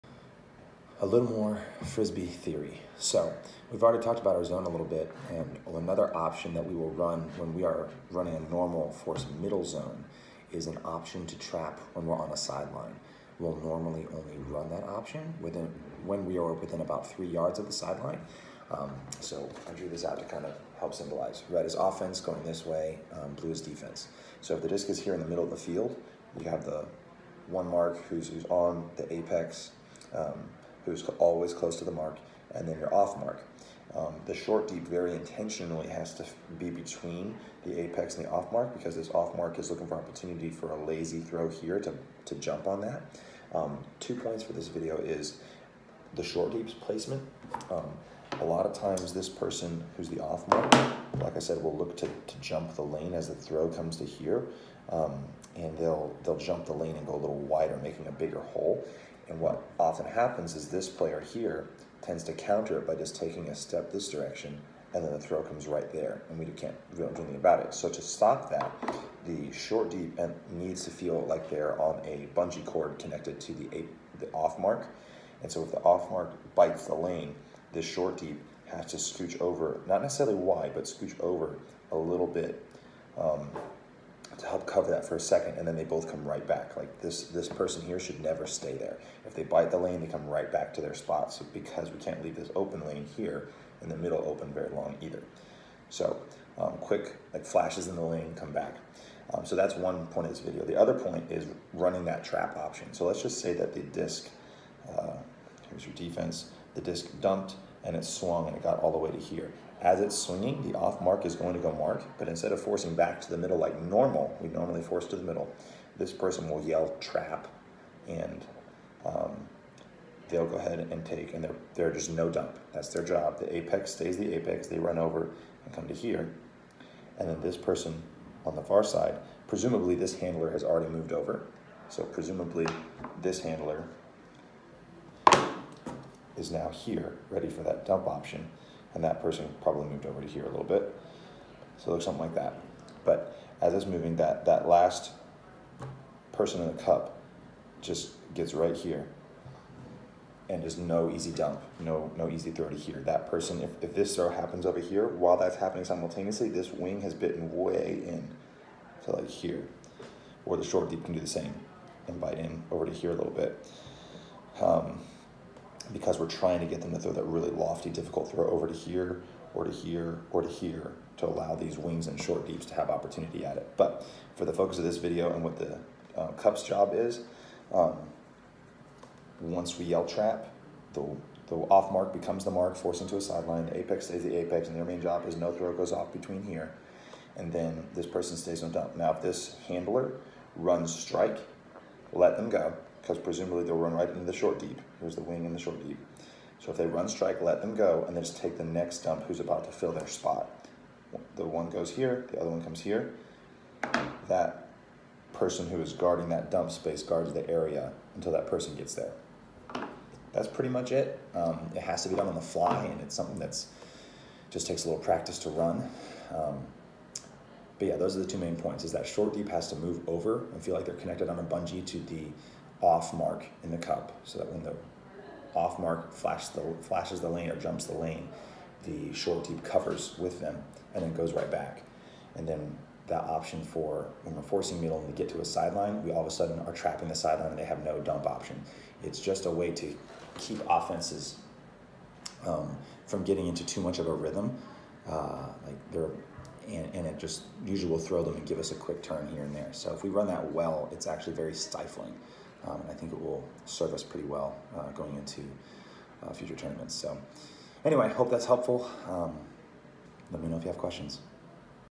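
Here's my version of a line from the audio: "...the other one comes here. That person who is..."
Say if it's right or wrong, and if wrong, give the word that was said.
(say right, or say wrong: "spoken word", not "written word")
right.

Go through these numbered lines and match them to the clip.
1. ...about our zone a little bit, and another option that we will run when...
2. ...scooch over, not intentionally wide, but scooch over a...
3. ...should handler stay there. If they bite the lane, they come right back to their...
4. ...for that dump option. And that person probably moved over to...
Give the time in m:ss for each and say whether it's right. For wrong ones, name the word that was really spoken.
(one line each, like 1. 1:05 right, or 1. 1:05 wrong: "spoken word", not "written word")
1. 0:04 right
2. 1:18 wrong: "necessarily", not "intentionally"
3. 1:27 wrong: "never", not "handler"
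4. 2:17 right.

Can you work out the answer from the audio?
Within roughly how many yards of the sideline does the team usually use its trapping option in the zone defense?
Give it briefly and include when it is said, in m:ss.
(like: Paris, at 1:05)
3 yards, at 0:17.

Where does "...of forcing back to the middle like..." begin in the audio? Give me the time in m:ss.
1:52.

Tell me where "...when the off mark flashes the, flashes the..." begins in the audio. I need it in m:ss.
3:44.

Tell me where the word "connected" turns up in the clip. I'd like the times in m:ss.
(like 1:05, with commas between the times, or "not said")
1:12, 3:40.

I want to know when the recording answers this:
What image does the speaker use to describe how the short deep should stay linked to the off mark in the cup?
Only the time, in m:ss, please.
1:12.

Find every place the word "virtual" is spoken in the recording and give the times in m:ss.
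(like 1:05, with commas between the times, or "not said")
not said.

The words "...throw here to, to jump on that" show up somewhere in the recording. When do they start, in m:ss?
0:41.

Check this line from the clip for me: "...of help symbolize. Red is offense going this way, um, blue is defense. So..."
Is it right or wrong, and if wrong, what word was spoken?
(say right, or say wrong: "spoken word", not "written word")
right.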